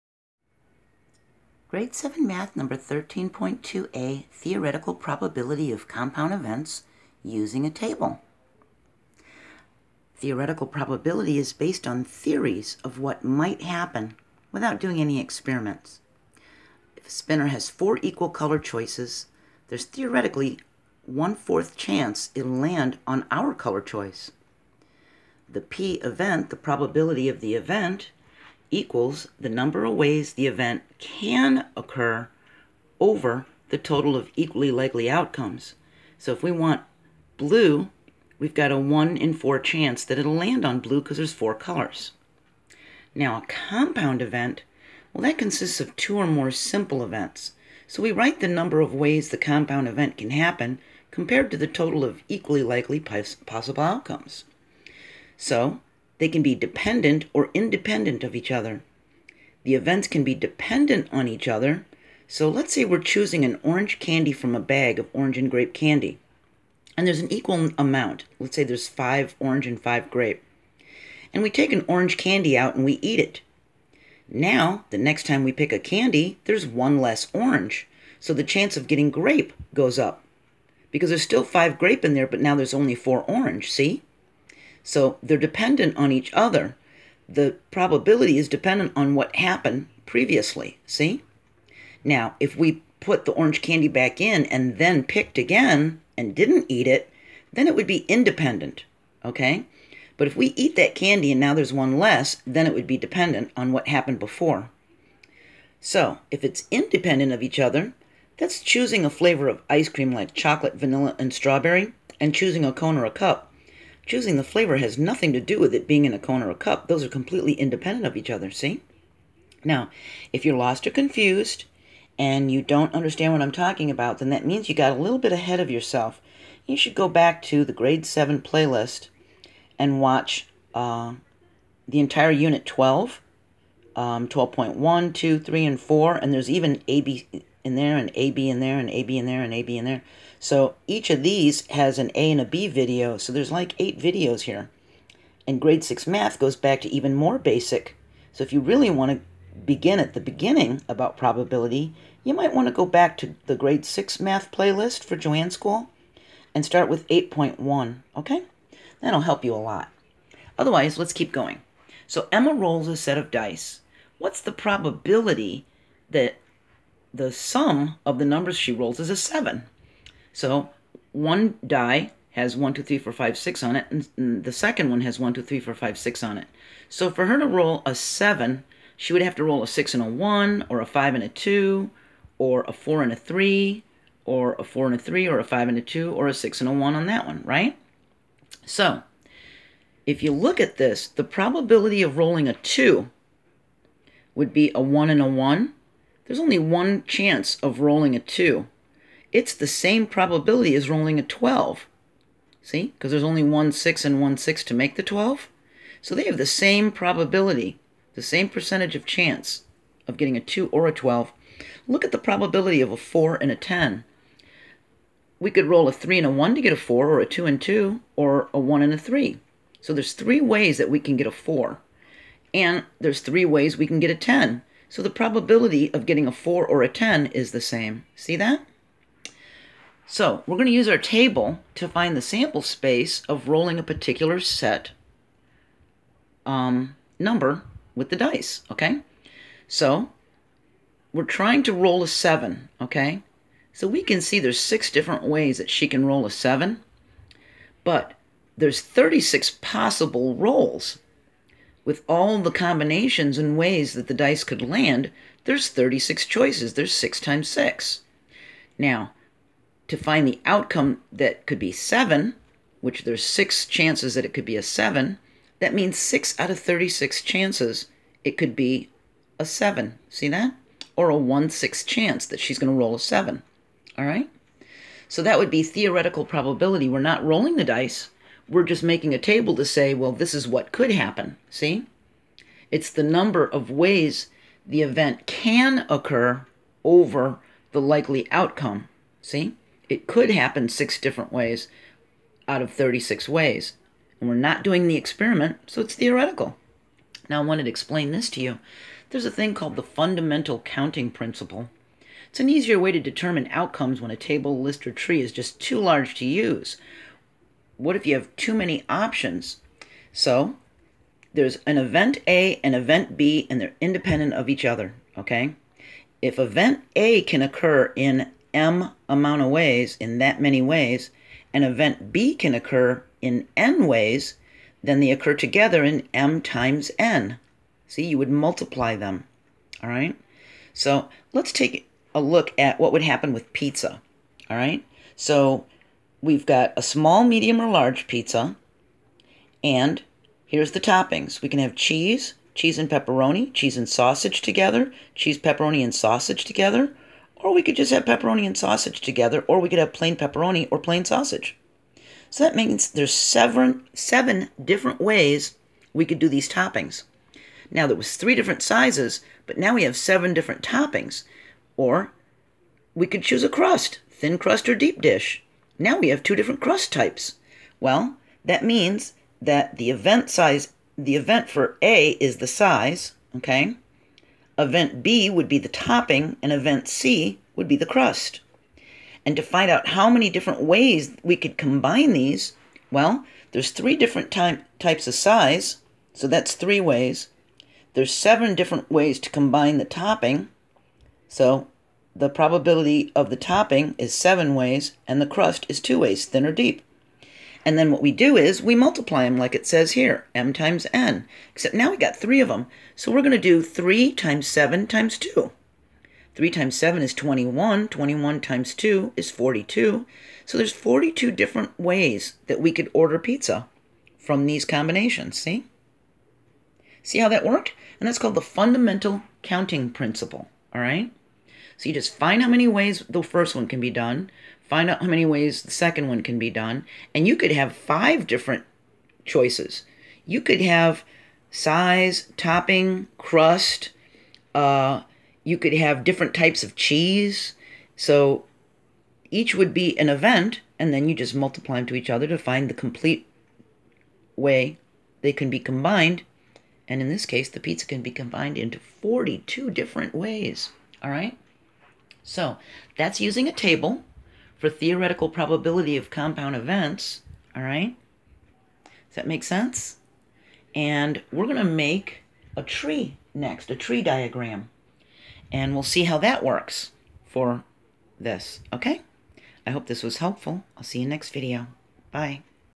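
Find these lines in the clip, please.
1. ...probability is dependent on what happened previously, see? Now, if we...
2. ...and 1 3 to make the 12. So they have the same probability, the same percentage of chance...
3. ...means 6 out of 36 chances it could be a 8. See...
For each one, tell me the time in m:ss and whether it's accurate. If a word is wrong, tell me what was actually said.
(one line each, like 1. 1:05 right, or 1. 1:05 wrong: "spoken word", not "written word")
1. 1:27 right
2. 3:24 wrong: "6", not "3"
3. 4:25 wrong: "7", not "8".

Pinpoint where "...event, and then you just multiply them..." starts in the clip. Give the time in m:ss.
7:20.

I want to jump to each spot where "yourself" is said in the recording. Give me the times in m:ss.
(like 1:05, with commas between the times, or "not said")
2:05.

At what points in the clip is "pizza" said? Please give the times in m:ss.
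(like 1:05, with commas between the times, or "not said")
5:33, 5:38, 6:53, 7:27.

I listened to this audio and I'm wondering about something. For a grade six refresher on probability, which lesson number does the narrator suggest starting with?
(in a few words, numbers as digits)
8.1.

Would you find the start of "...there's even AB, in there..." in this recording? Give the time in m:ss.
2:16.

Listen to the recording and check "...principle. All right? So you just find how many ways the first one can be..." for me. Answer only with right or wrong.
right.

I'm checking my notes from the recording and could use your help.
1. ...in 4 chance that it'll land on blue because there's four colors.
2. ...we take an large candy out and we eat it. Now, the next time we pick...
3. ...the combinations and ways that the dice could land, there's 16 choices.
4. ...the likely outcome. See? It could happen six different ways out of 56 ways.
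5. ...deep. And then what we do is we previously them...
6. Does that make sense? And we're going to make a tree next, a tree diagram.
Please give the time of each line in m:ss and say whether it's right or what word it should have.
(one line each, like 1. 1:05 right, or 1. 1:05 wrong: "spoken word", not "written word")
1. 0:39 right
2. 1:11 wrong: "orange", not "large"
3. 4:12 wrong: "36", not "16"
4. 4:47 wrong: "36", not "56"
5. 6:36 wrong: "multiply", not "previously"
6. 7:39 right.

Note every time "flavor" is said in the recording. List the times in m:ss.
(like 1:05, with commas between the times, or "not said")
1:49, 1:54.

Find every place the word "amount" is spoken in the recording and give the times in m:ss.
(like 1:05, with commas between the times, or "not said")
1:07, 5:19.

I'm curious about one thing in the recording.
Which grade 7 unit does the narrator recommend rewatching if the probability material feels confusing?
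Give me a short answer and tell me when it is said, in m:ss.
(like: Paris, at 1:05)
Unit 12, at 2:12.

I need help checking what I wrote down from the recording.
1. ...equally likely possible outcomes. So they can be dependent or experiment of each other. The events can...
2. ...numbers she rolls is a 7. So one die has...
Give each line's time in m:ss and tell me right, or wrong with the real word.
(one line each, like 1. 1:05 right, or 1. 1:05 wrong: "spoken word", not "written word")
1. 0:52 wrong: "independent", not "experiment"
2. 2:48 right.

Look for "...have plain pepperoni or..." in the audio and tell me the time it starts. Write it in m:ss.
5:49.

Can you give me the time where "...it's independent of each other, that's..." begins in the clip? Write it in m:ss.
1:46.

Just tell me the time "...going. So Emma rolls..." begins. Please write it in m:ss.
2:41.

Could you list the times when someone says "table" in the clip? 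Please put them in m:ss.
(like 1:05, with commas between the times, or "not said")
0:07, 3:50, 4:39, 5:04, 7:33.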